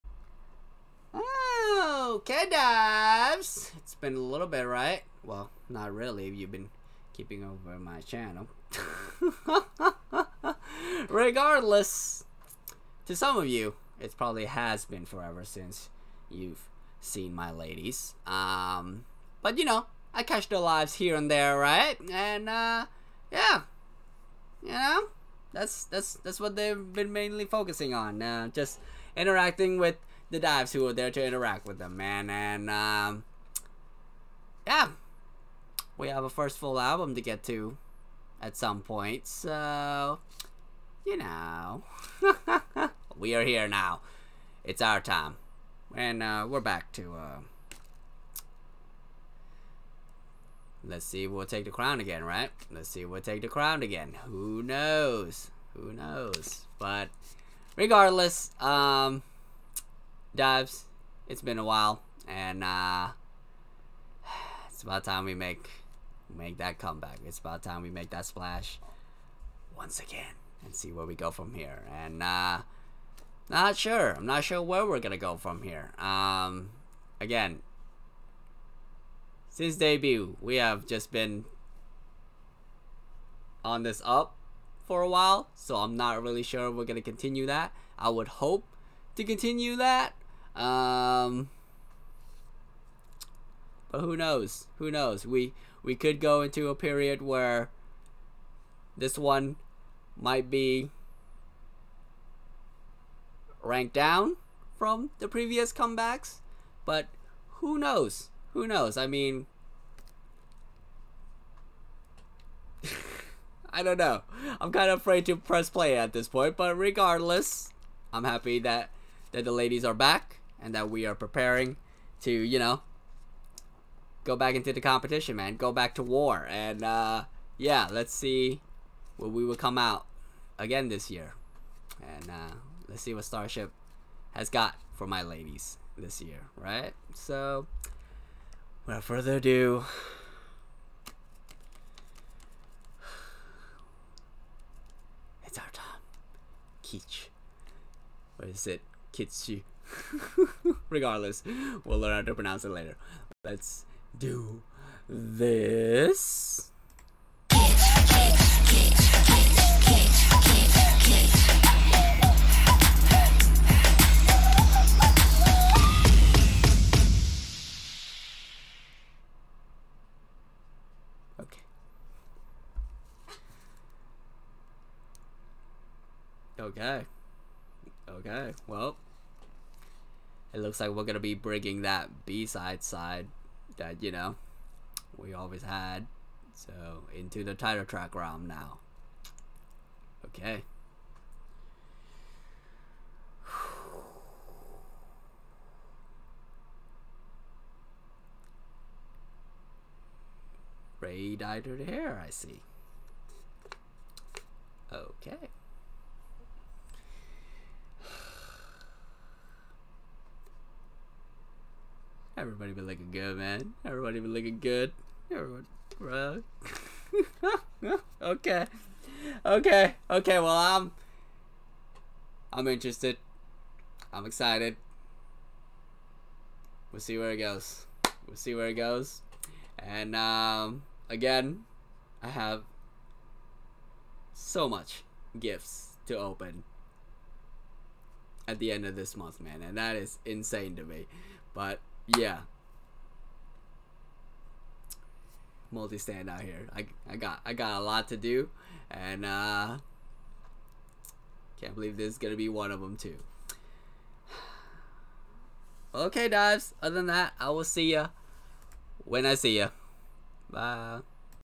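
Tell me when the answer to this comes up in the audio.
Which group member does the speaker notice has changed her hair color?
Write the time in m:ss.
3:20.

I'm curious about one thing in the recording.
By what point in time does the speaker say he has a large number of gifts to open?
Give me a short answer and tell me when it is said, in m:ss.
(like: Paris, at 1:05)
End of this month, at 3:58.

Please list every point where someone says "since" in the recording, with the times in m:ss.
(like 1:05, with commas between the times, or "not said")
0:15, 1:19.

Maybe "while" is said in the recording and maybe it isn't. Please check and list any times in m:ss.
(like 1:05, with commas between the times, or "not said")
1:01, 1:25.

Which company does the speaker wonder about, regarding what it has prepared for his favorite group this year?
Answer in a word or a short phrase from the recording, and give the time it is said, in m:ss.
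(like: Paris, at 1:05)
Starship, at 2:13.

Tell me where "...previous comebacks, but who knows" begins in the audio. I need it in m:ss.
1:45.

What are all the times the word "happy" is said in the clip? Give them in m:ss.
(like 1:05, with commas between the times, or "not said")
1:58.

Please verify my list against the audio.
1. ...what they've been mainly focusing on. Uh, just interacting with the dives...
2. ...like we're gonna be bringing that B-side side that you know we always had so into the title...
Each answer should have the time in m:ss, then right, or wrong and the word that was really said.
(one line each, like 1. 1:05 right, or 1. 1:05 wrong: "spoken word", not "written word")
1. 0:26 right
2. 3:00 right.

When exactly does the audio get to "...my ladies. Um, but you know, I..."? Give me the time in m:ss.
0:17.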